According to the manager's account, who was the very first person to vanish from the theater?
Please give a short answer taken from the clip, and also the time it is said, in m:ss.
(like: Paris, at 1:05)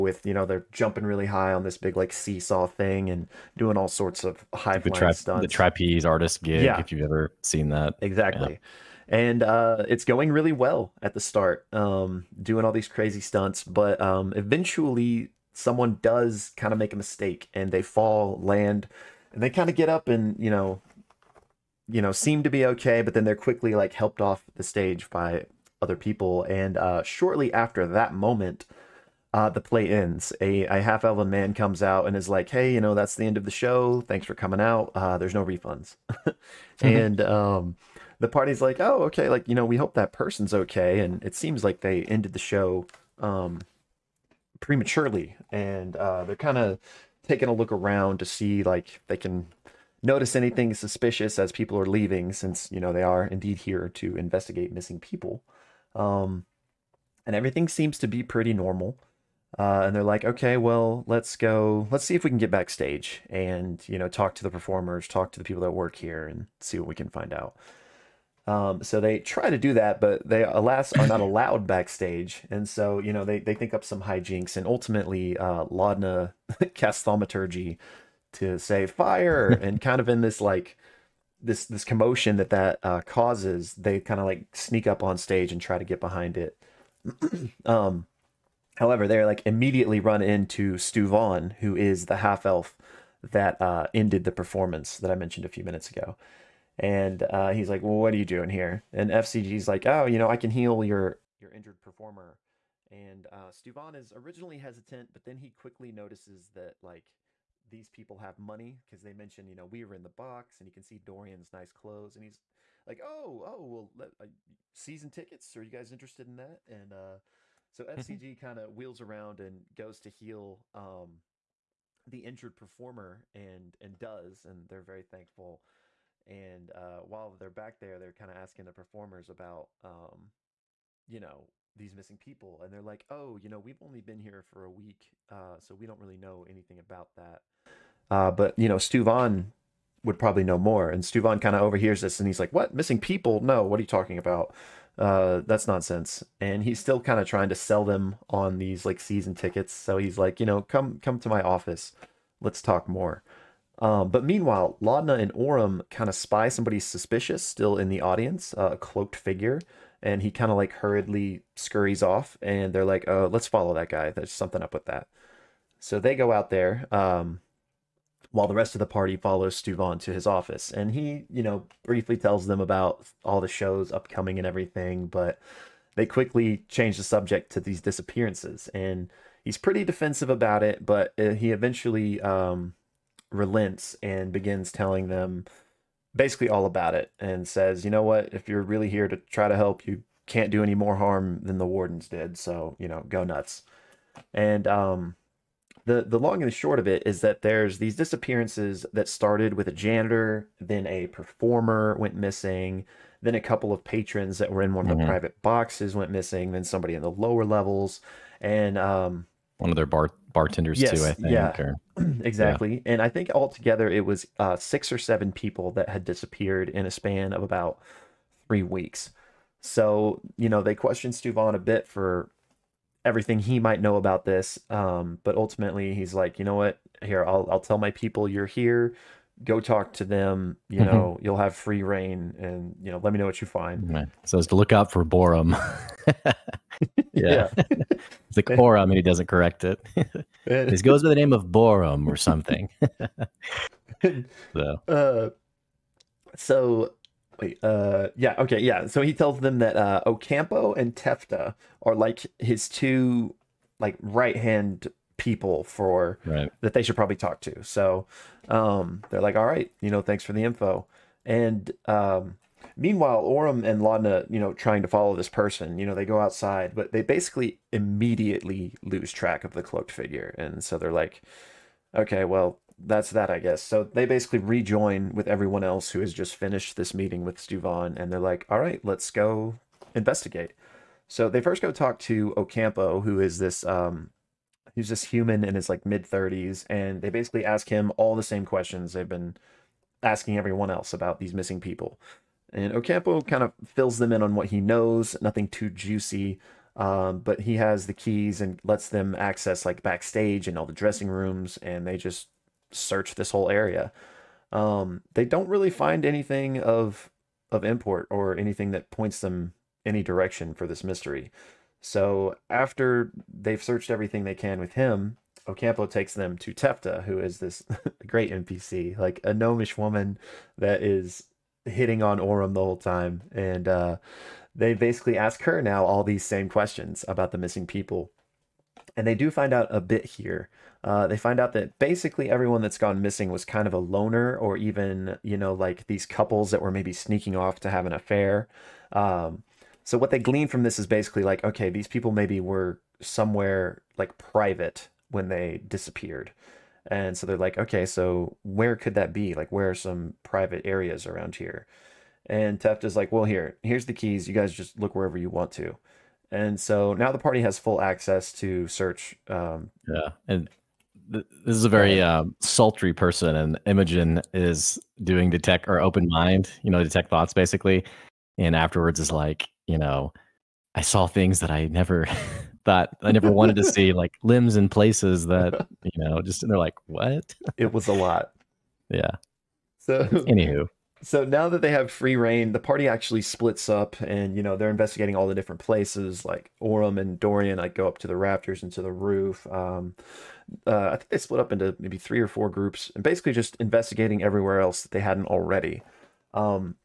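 a janitor, at 3:19.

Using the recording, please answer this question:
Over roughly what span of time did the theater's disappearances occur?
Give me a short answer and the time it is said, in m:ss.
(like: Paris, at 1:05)
about three weeks, at 3:37.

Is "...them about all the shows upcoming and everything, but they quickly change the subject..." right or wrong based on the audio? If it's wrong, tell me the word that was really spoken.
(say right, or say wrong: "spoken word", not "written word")
right.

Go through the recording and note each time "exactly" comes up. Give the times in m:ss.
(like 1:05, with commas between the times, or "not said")
0:08, 3:32.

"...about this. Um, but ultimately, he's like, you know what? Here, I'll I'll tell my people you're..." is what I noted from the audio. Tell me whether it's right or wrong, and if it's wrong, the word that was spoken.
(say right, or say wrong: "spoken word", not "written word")
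right.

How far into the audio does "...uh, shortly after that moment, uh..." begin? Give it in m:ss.
0:26.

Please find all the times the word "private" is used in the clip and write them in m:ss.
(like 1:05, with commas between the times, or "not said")
3:25, 5:44, 5:50.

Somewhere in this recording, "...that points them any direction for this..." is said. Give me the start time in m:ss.
5:08.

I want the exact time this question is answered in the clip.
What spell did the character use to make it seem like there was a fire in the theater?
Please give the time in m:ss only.
1:17.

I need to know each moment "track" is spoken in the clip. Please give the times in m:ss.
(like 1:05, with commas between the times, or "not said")
4:29.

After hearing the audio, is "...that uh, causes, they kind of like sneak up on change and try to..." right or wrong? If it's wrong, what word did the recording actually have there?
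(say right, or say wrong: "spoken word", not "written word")
wrong: "stage", not "change".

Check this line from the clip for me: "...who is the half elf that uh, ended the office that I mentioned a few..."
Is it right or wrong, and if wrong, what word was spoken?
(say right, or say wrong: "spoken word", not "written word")
wrong: "performance", not "office".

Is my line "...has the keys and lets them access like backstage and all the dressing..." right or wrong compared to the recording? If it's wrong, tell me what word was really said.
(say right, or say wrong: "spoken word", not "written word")
right.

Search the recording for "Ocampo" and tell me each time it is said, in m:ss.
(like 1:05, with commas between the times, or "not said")
4:10, 4:42, 4:52, 5:15.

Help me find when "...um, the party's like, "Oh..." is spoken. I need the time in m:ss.
0:37.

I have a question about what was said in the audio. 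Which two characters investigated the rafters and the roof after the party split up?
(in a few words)
Orym and Dorian.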